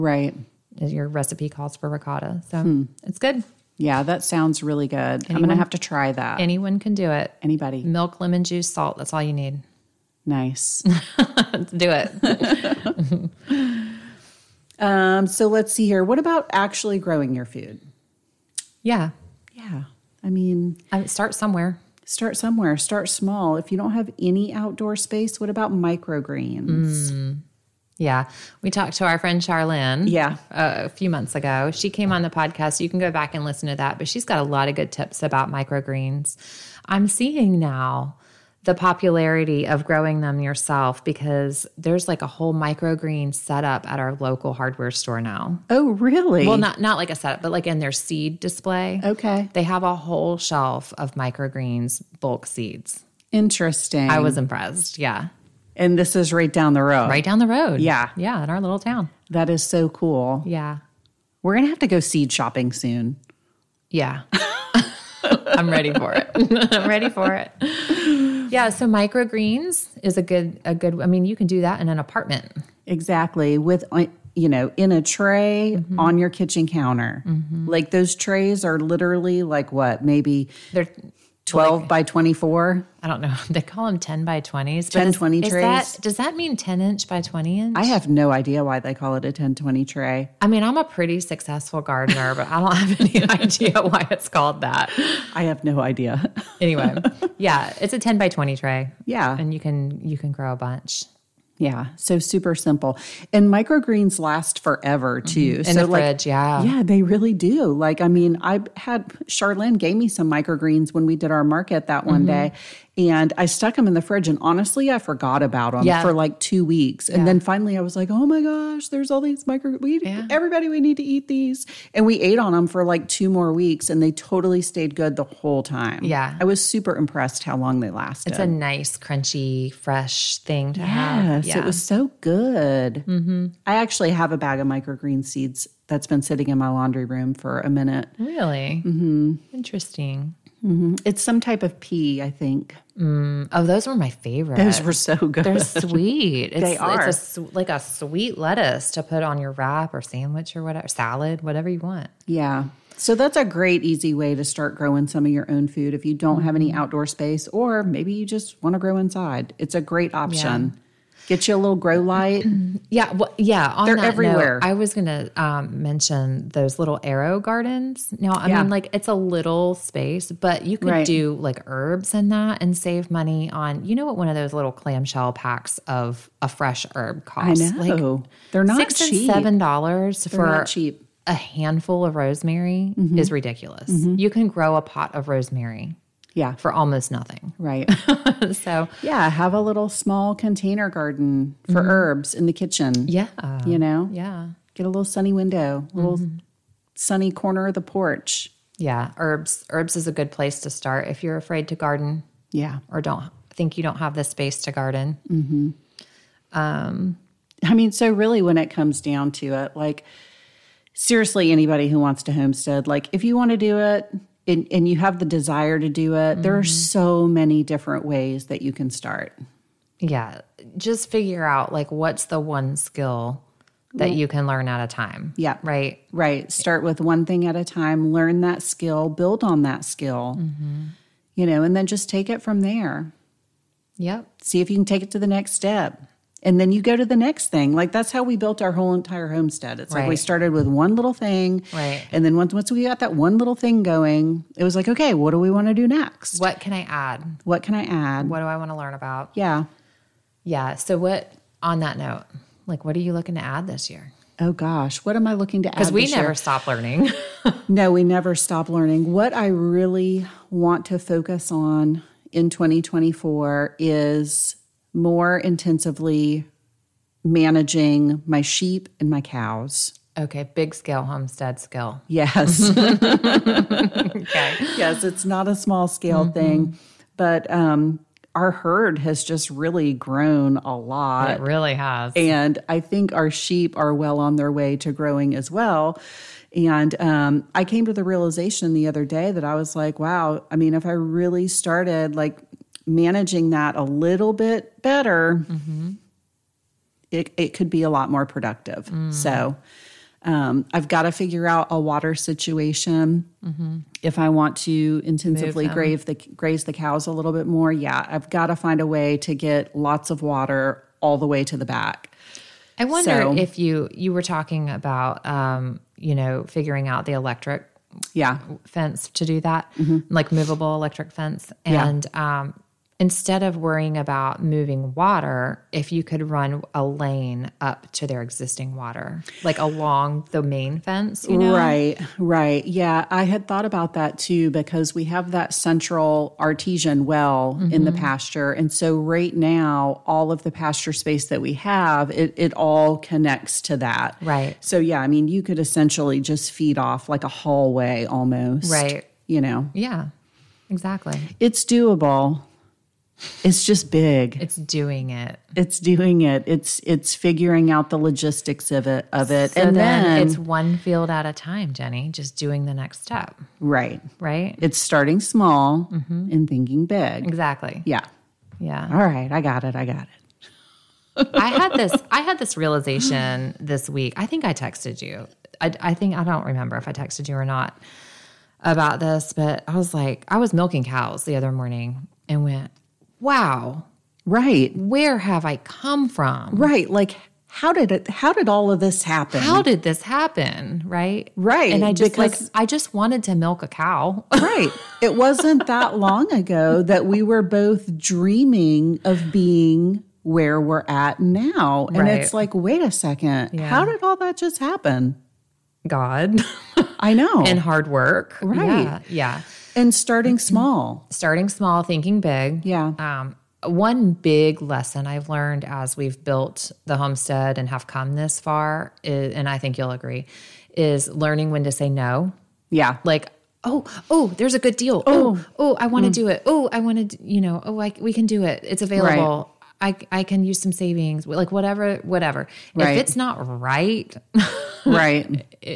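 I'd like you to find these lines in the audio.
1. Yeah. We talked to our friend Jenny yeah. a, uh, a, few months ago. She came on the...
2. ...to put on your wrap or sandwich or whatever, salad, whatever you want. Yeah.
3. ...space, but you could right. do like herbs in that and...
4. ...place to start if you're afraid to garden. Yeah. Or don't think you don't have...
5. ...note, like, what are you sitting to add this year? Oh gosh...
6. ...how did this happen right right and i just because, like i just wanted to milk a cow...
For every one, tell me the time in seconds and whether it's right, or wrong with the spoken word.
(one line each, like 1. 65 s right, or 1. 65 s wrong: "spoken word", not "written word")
1. 27 s wrong: "Charlene", not "Jenny"
2. 148 s right
3. 169 s right
4. 200 s right
5. 251 s wrong: "looking", not "sitting"
6. 389 s right.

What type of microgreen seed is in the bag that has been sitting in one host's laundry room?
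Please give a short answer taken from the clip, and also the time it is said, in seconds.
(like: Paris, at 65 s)
pea, at 141 s.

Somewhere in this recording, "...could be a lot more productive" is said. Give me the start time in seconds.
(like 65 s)
297 s.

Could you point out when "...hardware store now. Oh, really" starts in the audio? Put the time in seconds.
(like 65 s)
44 s.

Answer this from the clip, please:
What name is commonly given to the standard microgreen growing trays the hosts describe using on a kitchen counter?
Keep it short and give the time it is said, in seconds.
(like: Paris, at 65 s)
10 by 20, at 83 s.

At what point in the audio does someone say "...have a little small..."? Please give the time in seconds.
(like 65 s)
189 s.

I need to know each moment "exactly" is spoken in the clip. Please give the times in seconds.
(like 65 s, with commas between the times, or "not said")
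72 s, 350 s, 367 s.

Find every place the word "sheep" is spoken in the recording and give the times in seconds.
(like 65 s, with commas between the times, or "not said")
268 s, 283 s.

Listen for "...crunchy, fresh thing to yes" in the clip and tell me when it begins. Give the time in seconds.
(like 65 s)
128 s.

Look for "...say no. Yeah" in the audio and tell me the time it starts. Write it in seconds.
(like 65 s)
421 s.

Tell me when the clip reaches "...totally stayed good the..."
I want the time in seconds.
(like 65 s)
124 s.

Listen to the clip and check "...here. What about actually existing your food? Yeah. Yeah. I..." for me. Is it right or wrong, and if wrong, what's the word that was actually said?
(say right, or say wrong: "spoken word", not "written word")
wrong: "growing", not "existing".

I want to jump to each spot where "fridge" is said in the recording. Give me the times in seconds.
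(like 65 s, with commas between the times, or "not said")
106 s, 114 s.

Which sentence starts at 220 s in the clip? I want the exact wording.
Just figure out like what's the one skill that you can learn at a time.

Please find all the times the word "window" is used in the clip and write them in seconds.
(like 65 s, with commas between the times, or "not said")
195 s.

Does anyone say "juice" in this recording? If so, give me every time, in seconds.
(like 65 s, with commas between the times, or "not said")
8 s.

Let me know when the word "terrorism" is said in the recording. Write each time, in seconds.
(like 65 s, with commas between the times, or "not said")
not said.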